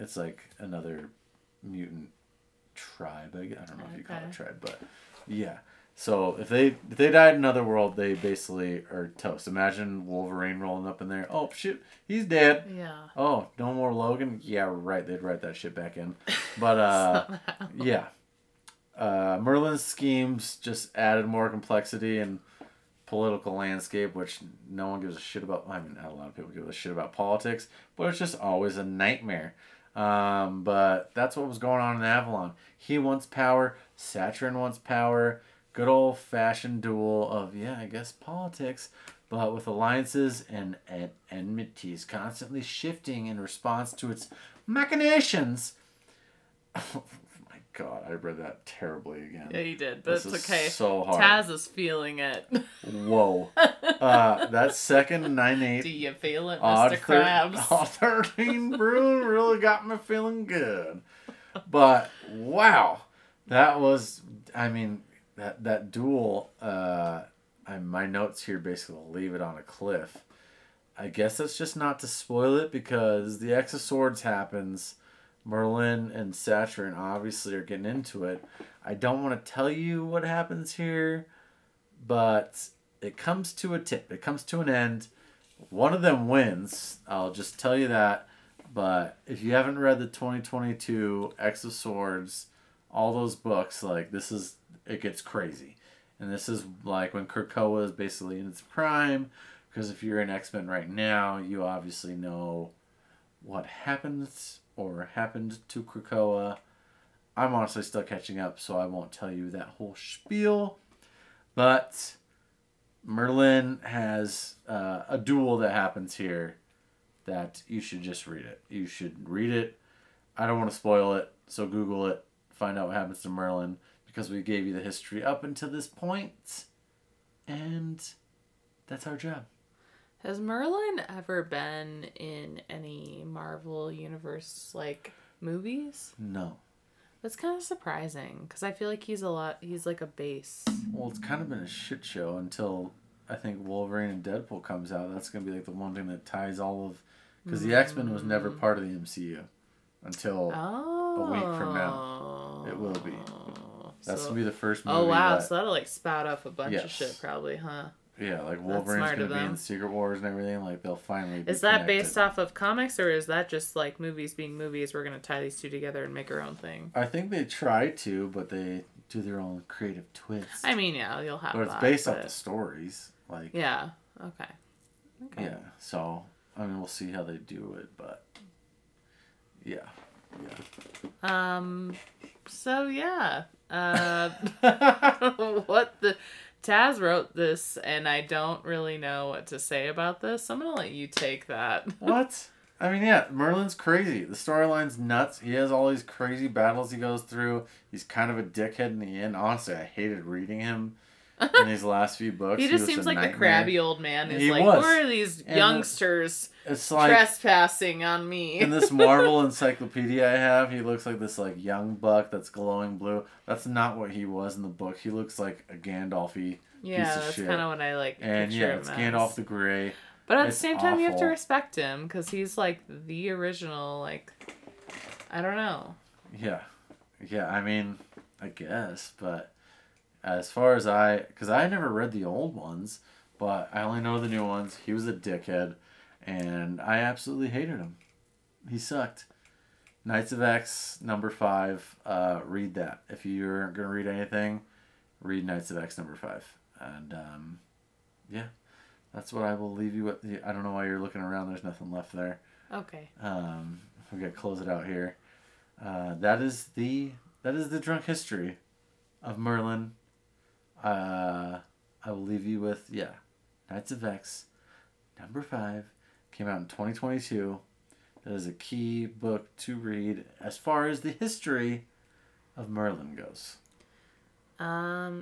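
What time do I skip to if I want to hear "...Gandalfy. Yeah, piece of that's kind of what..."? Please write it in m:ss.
3:35.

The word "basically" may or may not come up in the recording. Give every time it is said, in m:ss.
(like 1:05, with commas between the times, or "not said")
0:08, 1:08, 1:37.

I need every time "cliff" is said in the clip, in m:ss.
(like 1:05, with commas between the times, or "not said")
1:09.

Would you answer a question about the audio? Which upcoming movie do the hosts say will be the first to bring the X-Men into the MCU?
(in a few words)
Wolverine and Deadpool.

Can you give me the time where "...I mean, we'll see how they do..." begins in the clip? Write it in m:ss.
2:56.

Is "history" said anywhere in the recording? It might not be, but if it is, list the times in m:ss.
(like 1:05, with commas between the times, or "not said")
2:04, 4:18, 4:31.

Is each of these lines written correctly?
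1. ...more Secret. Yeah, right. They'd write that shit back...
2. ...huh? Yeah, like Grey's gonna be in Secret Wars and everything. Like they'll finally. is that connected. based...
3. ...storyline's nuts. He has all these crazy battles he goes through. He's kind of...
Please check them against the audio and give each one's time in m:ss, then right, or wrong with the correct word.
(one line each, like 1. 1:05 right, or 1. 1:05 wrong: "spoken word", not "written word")
1. 0:13 wrong: "Logan", not "Secret"
2. 2:37 wrong: "Wolverine", not "Grey"
3. 3:14 right.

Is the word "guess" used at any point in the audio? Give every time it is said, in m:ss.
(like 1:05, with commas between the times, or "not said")
0:37, 1:11, 3:48.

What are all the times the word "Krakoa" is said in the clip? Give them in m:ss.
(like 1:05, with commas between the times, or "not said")
1:37, 1:45.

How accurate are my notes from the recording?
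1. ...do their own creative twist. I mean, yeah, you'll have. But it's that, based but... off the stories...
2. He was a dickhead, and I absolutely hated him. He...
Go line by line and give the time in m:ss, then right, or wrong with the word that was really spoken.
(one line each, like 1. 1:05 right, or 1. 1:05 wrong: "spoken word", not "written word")
1. 2:49 right
2. 3:54 right.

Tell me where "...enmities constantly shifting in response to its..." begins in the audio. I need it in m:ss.
0:41.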